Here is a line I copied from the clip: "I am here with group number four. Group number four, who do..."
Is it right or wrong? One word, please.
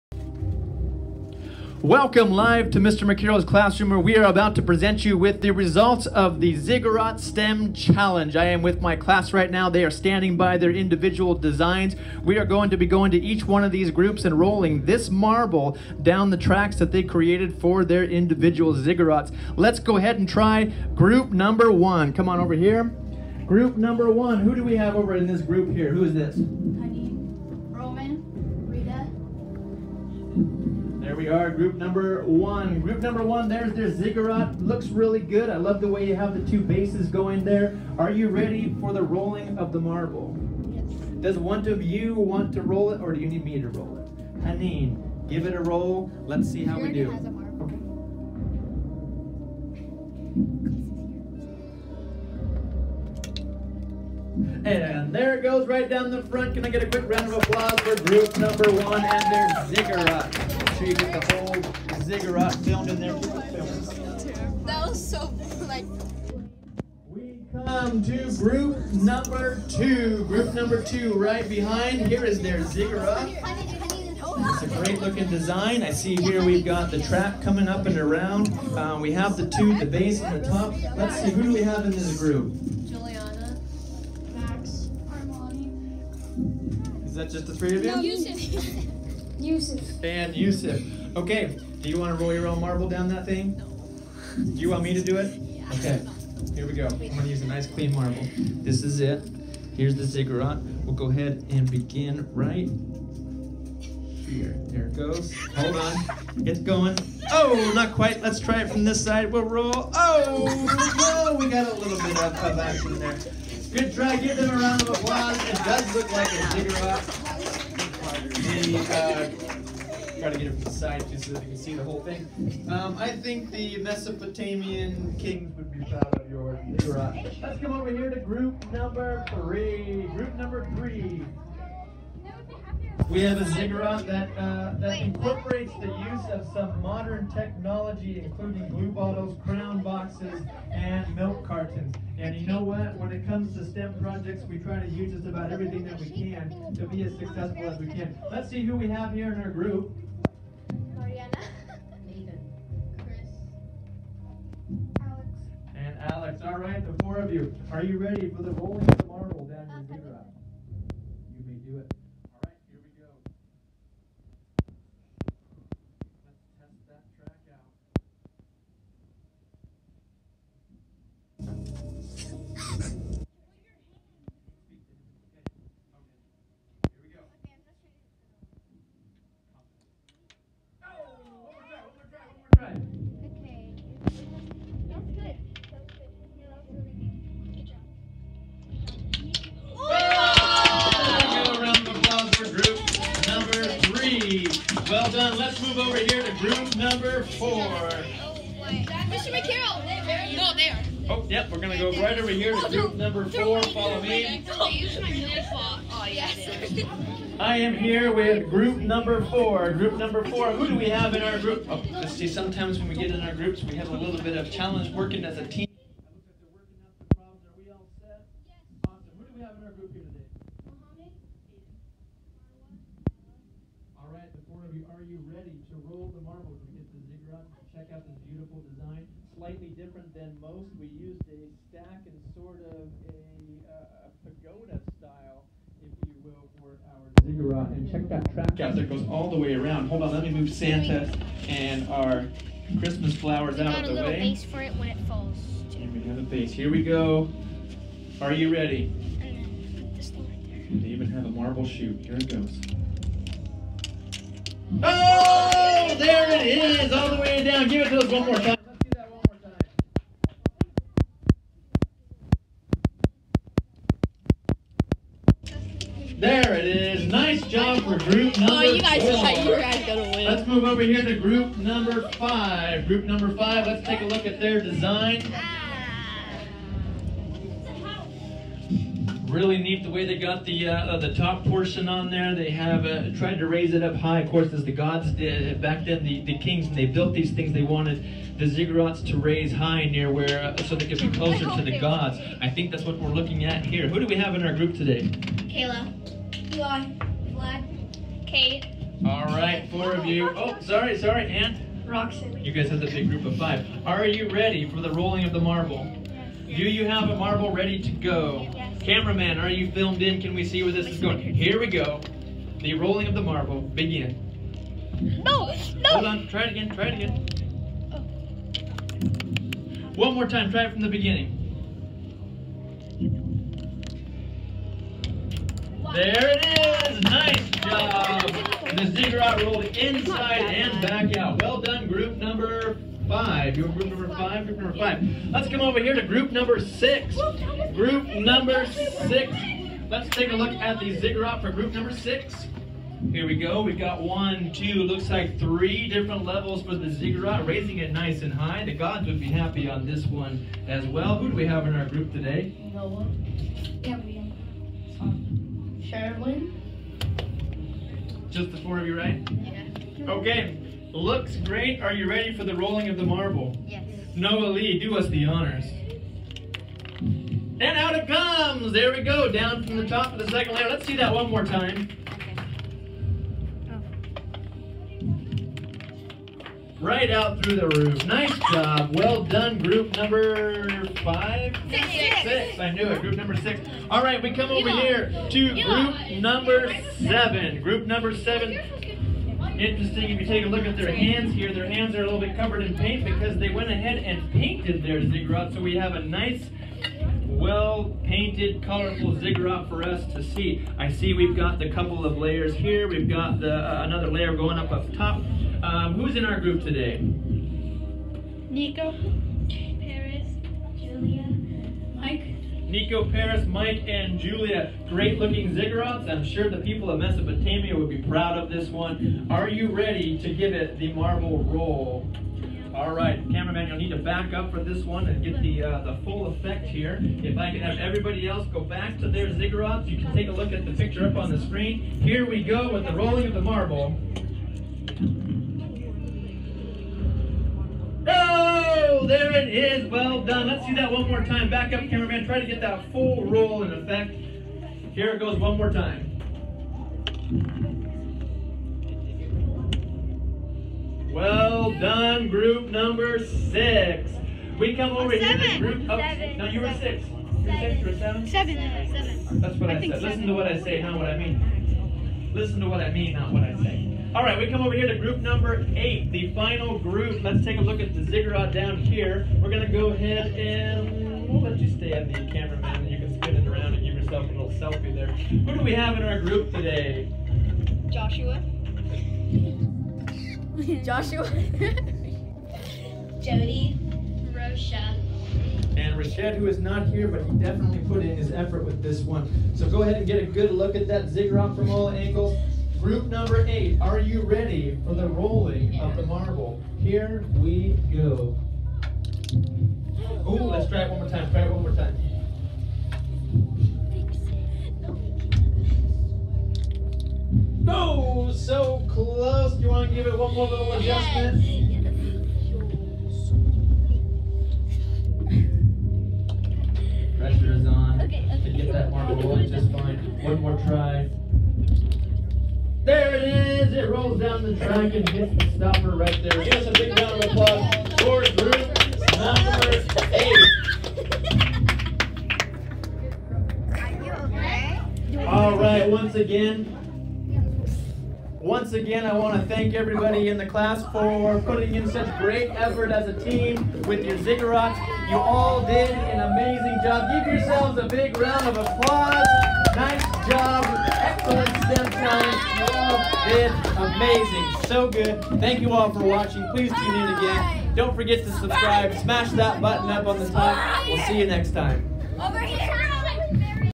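right.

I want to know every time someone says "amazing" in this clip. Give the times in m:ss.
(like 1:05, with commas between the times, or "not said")
9:06, 9:13.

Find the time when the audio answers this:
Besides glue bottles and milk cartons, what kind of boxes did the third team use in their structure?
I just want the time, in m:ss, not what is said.
2:19.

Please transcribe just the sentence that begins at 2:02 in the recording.
Um, I think the Mesopotamian kings would be proud of your Torah.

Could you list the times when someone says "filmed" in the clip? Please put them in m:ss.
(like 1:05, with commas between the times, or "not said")
1:02, 5:09.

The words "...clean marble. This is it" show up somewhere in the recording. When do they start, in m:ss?
1:37.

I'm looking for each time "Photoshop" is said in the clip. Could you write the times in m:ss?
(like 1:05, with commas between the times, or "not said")
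not said.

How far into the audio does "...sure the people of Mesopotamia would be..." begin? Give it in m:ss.
6:56.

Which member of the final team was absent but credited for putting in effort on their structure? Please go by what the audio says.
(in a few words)
Rashad.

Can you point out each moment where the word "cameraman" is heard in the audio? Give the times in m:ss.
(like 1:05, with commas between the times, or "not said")
5:08, 7:03, 7:21, 7:52.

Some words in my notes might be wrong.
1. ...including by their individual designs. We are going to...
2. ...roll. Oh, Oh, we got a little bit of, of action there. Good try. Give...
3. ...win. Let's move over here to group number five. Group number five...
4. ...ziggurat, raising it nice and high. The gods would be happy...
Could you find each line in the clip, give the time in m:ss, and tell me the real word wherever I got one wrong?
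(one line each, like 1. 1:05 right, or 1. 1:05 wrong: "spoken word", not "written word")
1. 0:09 wrong: "standing", not "including"
2. 1:49 right
3. 4:30 right
4. 5:46 right.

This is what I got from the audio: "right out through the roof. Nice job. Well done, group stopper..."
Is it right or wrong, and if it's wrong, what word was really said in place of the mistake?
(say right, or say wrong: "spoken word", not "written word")
wrong: "number", not "stopper".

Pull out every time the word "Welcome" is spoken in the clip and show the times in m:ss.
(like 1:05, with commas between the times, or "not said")
0:01.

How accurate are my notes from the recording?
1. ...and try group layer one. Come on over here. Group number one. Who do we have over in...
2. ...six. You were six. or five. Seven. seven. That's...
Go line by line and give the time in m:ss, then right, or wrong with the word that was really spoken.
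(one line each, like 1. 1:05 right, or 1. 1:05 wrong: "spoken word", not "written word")
1. 0:20 wrong: "number", not "layer"
2. 7:36 wrong: "seven", not "five".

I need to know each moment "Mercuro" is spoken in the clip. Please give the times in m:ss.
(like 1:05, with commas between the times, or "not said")
0:03, 3:19.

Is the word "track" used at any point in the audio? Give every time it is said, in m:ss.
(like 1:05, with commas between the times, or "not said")
0:16, 3:58, 8:44.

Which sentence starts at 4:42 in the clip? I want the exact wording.
They have uh, tried to raise it up high.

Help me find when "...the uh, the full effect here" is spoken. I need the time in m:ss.
7:05.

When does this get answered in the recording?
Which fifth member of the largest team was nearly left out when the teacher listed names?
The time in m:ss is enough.
5:01.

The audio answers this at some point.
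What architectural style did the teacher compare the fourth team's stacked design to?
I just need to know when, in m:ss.
3:54.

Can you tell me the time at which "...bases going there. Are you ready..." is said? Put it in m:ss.
0:36.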